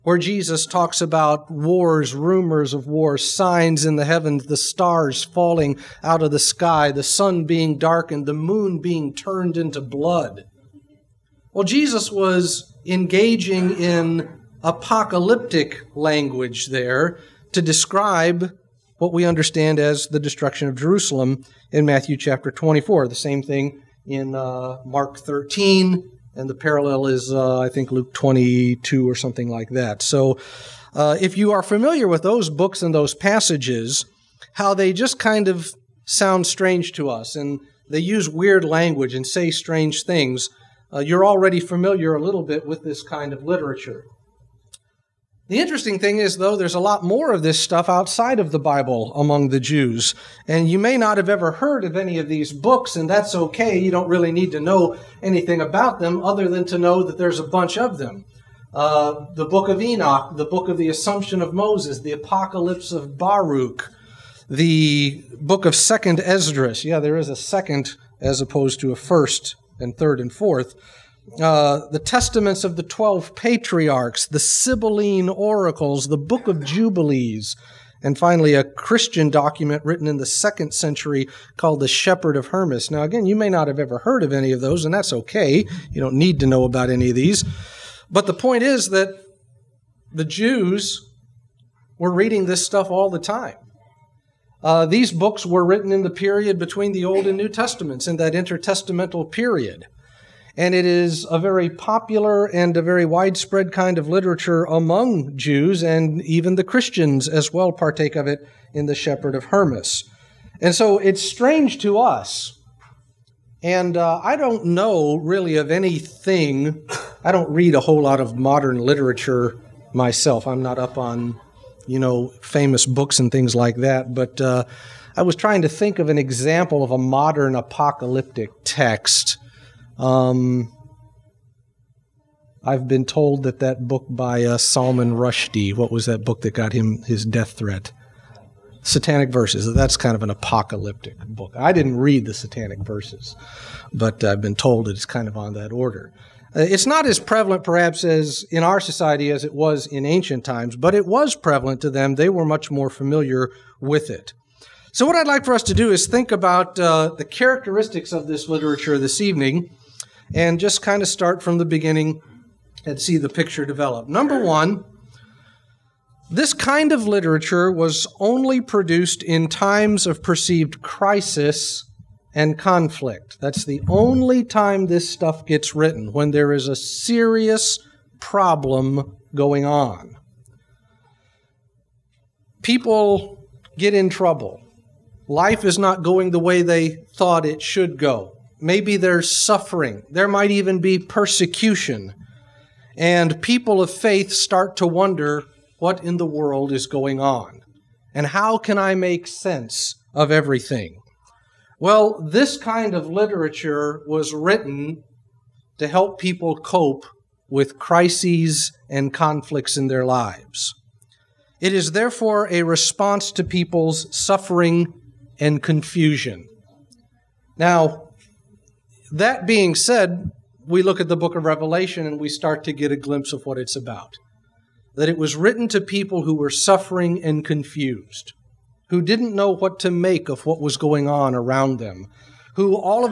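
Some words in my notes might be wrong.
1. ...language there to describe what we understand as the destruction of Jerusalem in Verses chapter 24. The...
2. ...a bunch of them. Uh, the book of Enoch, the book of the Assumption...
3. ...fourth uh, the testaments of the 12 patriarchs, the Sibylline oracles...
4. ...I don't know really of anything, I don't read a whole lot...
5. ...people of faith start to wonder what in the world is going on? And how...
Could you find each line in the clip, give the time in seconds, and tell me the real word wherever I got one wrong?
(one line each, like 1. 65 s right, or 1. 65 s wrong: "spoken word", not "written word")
1. 15 s wrong: "Matthew", not "Verses"
2. 57 s right
3. 70 s right
4. 114 s right
5. 193 s right.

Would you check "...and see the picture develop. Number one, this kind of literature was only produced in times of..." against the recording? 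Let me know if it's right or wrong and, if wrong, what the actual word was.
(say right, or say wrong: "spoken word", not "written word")
right.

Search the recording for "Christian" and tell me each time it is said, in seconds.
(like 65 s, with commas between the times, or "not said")
78 s, 106 s.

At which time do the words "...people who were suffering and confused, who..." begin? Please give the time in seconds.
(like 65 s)
225 s.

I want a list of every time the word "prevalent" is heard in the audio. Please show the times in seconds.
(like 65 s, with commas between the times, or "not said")
147 s, 151 s.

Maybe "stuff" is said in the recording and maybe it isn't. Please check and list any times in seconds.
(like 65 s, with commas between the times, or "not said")
47 s, 92 s, 175 s.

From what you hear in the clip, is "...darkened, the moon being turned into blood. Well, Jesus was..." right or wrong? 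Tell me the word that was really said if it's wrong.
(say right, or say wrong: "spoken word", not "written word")
right.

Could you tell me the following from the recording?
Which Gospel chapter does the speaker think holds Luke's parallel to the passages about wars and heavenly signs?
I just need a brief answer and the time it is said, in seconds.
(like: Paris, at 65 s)
Luke 22, at 27 s.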